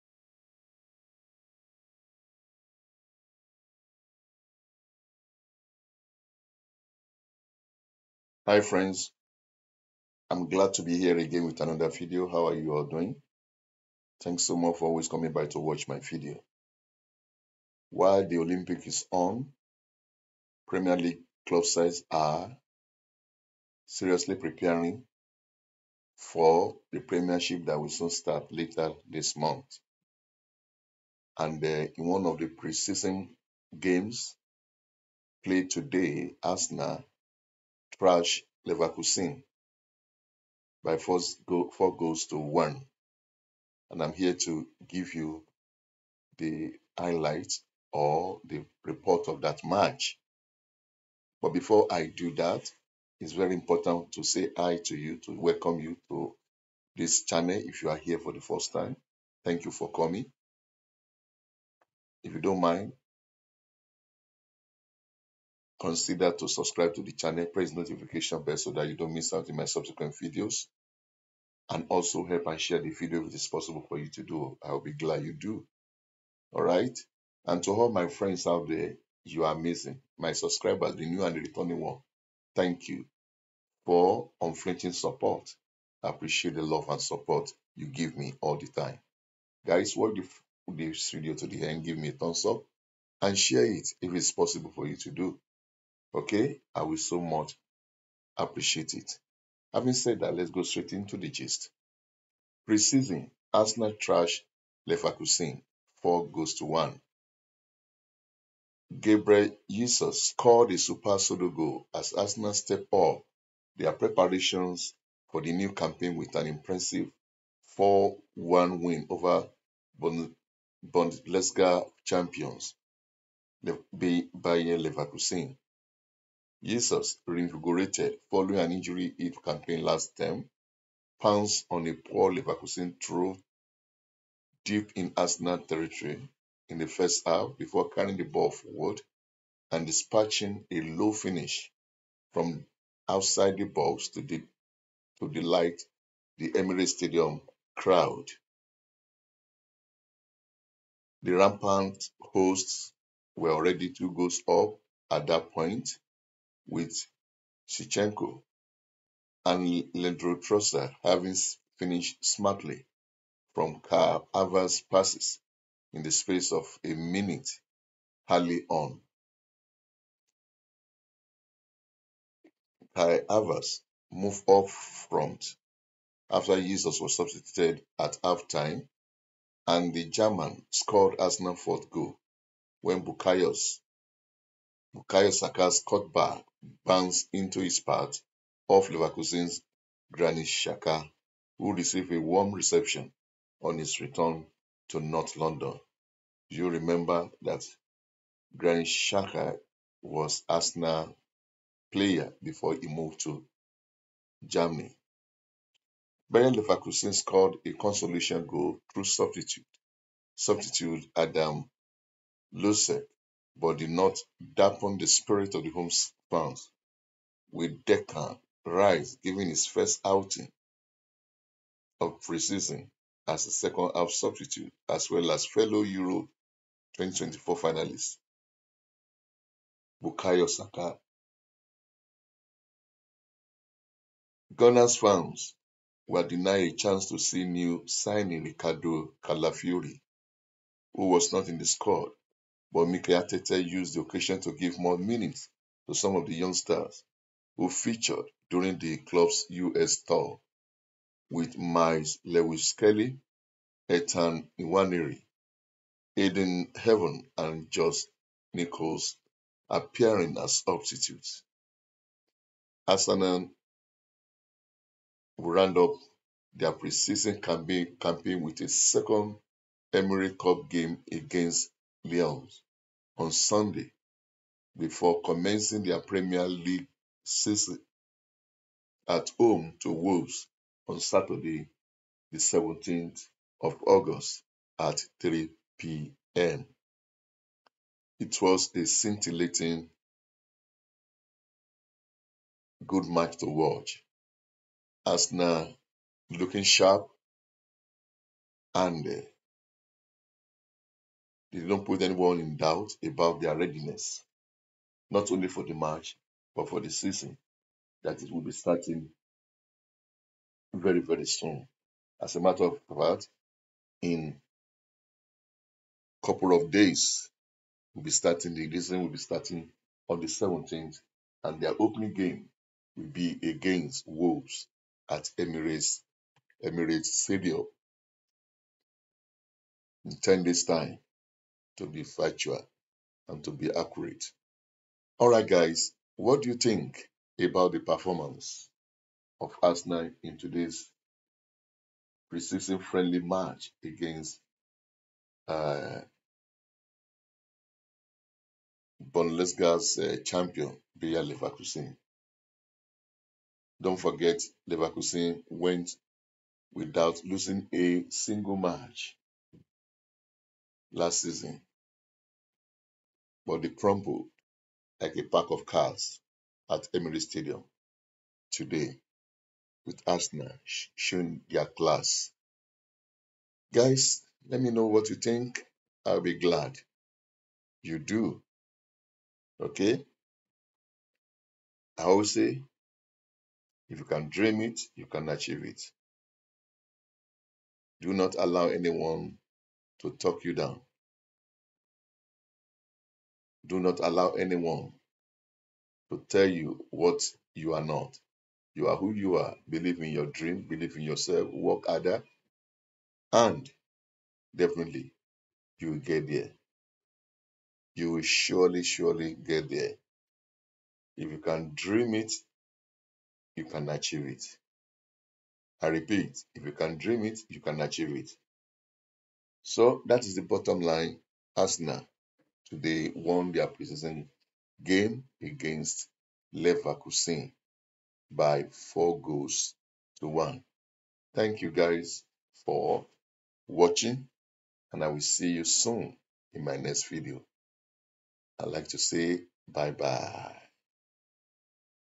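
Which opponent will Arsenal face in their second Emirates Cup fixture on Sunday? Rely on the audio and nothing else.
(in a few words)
Leeds.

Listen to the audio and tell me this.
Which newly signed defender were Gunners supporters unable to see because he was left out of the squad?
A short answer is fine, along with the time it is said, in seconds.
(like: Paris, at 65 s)
Ricardo Calafiori, at 238 s.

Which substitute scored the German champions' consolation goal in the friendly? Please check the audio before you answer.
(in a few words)
Adam Hložek.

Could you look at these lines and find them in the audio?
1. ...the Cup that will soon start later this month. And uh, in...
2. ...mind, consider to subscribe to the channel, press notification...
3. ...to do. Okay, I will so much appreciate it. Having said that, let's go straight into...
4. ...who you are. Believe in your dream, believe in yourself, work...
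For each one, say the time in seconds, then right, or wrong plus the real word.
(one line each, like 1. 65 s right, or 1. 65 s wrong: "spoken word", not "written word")
1. 26 s wrong: "Premiership", not "Cup"
2. 62 s right
3. 94 s right
4. 398 s right.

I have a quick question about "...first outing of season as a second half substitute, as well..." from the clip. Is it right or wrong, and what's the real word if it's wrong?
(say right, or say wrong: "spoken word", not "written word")
wrong: "preseason", not "season".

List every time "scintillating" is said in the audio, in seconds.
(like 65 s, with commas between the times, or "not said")
288 s.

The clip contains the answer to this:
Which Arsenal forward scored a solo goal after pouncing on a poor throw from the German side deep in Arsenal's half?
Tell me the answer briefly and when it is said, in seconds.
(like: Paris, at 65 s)
Gabriel Jesus, at 108 s.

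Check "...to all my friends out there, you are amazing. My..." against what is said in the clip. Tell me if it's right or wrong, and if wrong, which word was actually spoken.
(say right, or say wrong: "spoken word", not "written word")
right.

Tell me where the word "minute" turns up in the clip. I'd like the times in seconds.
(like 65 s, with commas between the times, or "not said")
166 s, 244 s.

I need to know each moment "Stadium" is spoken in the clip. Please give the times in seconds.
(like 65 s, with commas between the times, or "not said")
146 s, 327 s, 367 s.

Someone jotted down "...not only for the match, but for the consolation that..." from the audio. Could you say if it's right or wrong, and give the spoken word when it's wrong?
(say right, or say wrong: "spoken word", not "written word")
wrong: "season", not "consolation".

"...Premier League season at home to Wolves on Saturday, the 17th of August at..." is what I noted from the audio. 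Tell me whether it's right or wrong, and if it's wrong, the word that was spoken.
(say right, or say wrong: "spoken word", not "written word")
right.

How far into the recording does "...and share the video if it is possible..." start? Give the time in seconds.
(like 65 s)
72 s.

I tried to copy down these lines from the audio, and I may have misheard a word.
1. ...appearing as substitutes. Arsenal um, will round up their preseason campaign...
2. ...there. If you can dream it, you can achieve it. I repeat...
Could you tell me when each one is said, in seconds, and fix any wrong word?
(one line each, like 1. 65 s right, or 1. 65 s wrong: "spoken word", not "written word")
1. 259 s right
2. 409 s right.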